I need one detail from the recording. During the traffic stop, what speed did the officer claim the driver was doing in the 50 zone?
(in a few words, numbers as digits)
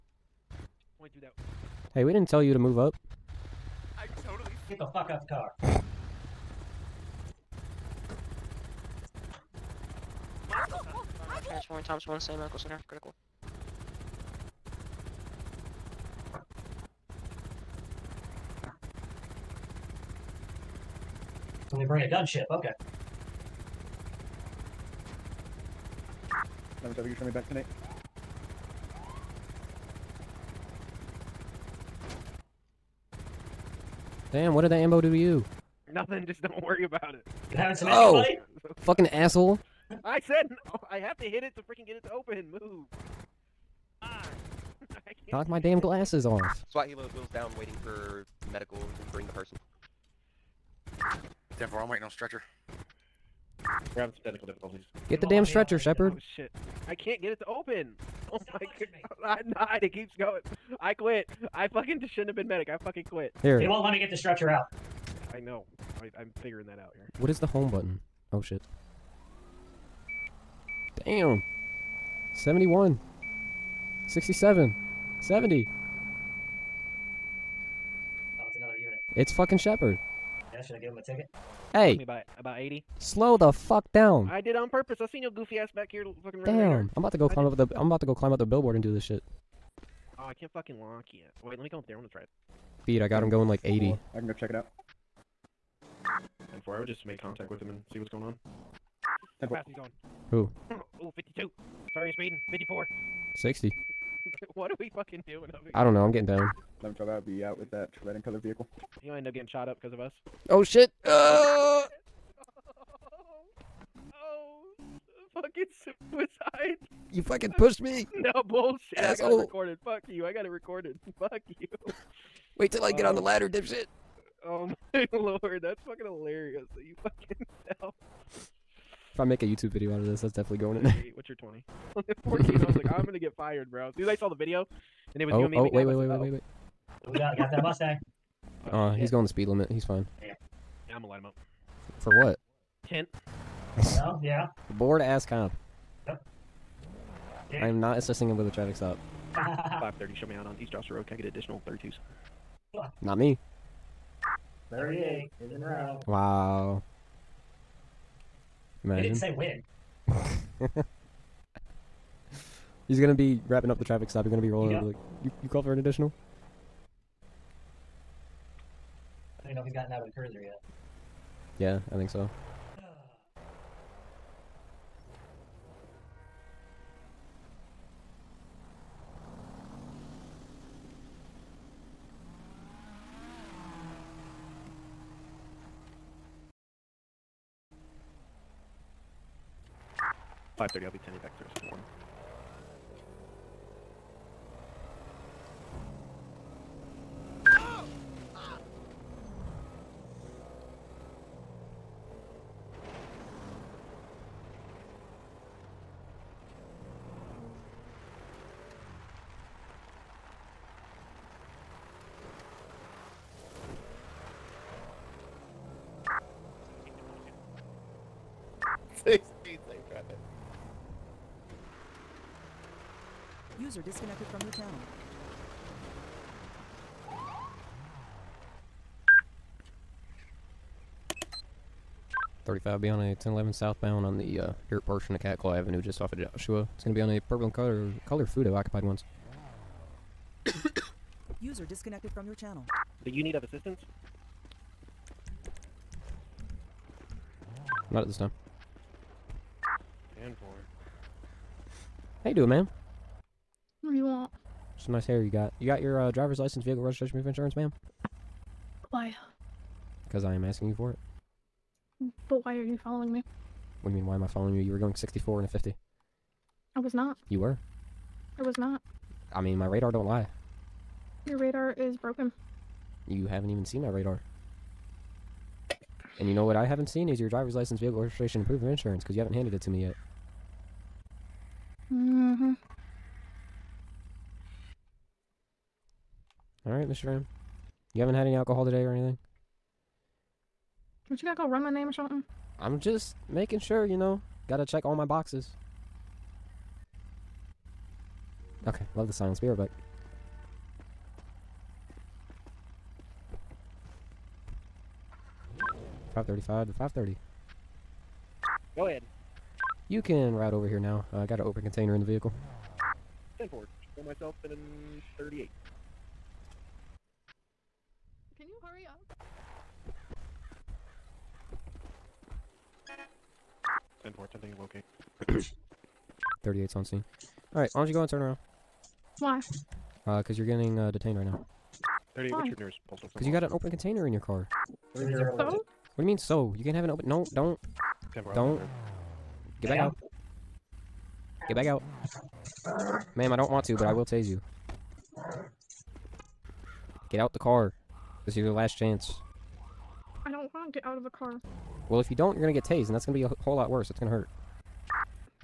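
64.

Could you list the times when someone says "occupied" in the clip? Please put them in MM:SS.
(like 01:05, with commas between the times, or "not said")
03:58.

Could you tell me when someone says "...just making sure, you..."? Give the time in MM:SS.
04:52.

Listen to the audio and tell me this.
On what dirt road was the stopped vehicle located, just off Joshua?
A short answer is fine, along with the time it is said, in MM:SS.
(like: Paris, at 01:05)
Catclaw Avenue, at 03:55.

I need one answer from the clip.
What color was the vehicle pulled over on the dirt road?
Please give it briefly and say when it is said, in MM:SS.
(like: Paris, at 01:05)
purple, at 03:57.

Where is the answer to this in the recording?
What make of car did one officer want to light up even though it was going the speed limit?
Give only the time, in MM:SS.
02:17.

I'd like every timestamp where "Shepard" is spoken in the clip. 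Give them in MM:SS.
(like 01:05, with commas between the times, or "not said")
00:55, 01:19.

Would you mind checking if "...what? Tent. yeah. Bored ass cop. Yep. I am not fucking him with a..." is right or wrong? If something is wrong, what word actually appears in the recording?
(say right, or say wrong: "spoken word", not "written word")
wrong: "assisting", not "fucking".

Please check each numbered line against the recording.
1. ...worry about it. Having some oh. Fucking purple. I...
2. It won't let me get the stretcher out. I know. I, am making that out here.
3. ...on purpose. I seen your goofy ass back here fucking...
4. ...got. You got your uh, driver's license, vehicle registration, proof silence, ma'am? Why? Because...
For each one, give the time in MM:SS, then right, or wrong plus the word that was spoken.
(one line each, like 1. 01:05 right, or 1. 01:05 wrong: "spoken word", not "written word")
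1. 00:36 wrong: "asshole", not "purple"
2. 01:03 wrong: "figuring", not "making"
3. 01:24 right
4. 04:15 wrong: "insurance", not "silence".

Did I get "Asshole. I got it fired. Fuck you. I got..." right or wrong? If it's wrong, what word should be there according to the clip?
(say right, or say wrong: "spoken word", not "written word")
wrong: "recorded", not "fired".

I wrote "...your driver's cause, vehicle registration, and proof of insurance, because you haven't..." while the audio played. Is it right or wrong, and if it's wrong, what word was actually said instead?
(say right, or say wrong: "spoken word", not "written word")
wrong: "license", not "cause".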